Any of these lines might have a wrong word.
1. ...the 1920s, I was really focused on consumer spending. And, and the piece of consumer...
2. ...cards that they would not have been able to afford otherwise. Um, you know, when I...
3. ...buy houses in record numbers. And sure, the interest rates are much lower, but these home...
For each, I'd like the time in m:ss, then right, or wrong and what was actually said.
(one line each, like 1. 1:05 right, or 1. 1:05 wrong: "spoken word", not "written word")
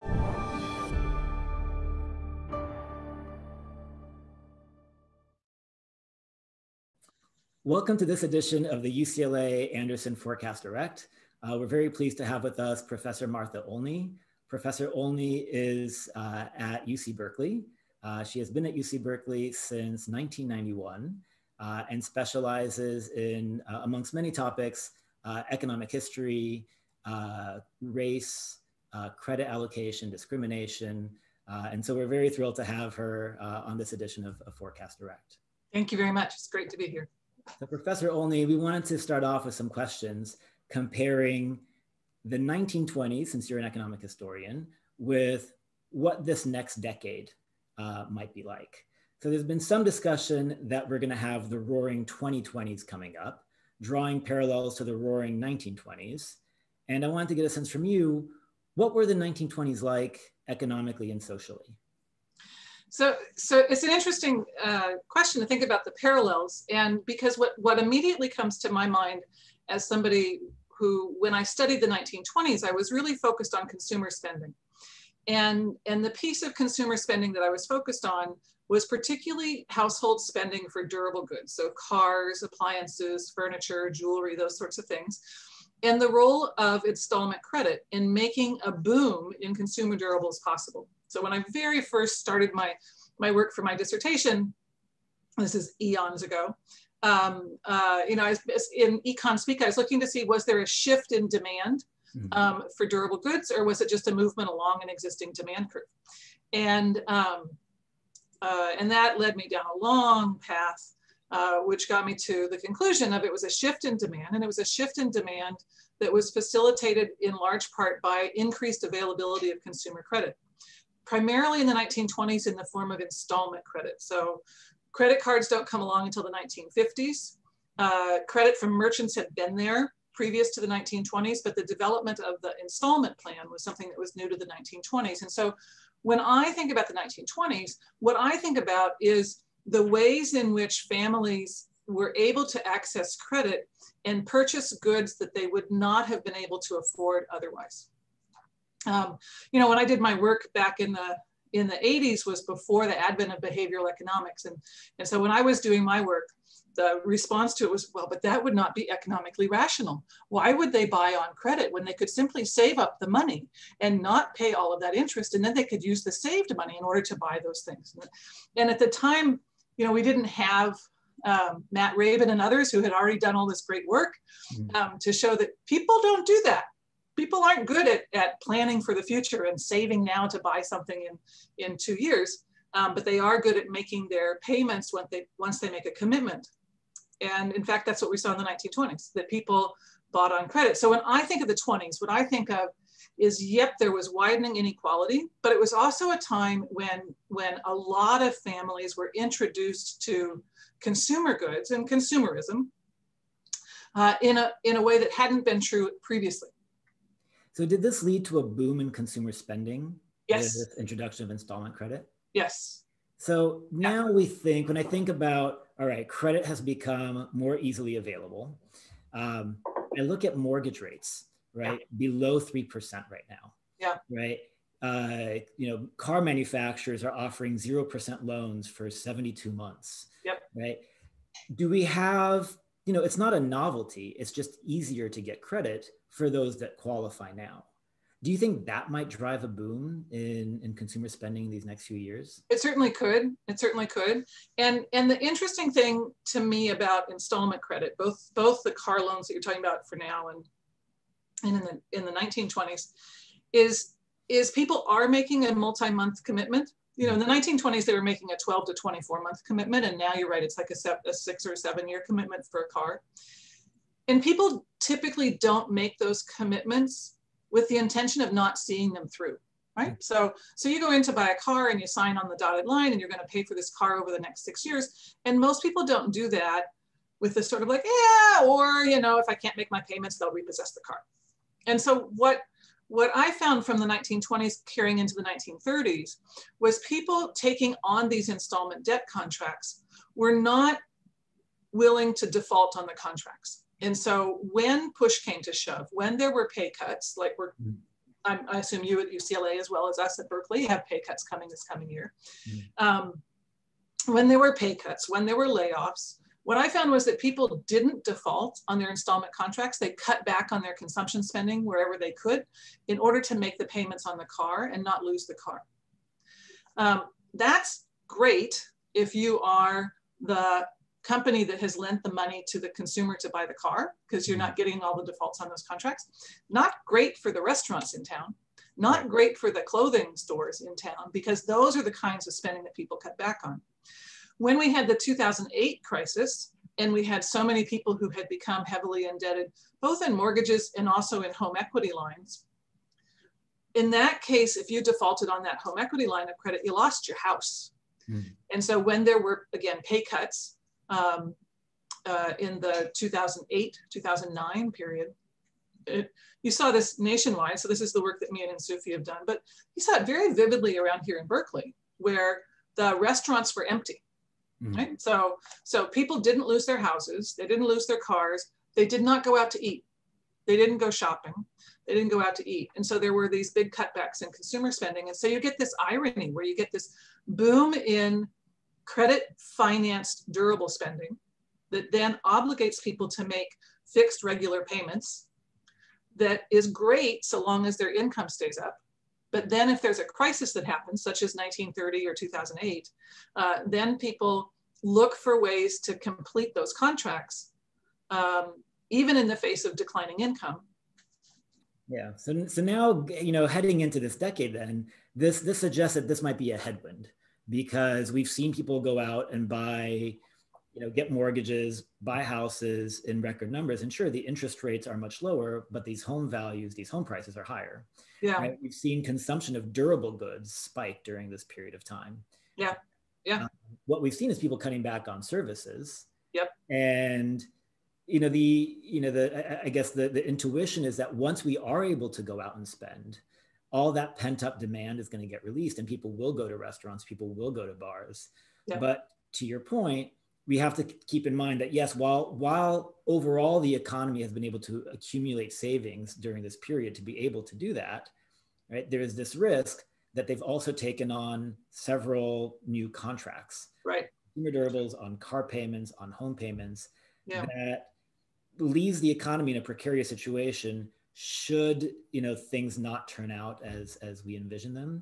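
1. 1:11 right
2. 2:24 wrong: "goods", not "cards"
3. 6:51 right.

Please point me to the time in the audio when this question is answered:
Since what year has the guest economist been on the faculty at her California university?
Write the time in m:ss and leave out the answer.
0:20.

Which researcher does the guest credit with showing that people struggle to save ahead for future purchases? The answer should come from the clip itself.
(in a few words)
Matt Rabin.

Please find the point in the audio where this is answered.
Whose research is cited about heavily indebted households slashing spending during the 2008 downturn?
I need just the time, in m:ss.
5:58.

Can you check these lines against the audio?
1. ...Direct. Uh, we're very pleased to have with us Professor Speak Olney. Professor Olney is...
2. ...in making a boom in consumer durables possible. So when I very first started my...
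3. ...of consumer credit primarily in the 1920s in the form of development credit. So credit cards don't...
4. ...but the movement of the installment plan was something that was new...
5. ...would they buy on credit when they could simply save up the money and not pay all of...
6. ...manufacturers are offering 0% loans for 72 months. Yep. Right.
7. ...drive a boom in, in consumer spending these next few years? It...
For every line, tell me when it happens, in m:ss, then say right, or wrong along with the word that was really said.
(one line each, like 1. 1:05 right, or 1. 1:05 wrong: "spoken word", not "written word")
1. 0:10 wrong: "Martha", not "Speak"
2. 1:27 right
3. 1:59 wrong: "installment", not "development"
4. 2:11 wrong: "development", not "movement"
5. 2:40 right
6. 3:46 right
7. 3:59 right.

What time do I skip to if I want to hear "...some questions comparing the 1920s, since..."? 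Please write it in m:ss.
0:39.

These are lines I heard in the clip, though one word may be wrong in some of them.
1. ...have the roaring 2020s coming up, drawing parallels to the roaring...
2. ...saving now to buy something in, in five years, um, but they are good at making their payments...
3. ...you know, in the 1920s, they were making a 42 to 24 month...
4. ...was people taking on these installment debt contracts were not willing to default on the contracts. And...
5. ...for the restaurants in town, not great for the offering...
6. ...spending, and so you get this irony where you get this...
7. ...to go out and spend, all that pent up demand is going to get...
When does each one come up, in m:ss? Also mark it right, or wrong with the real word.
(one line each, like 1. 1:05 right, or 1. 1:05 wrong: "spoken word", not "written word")
1. 0:51 right
2. 2:59 wrong: "two", not "five"
3. 4:16 wrong: "12", not "42"
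4. 4:46 right
5. 5:27 wrong: "clothing", not "offering"
6. 6:14 right
7. 7:12 right.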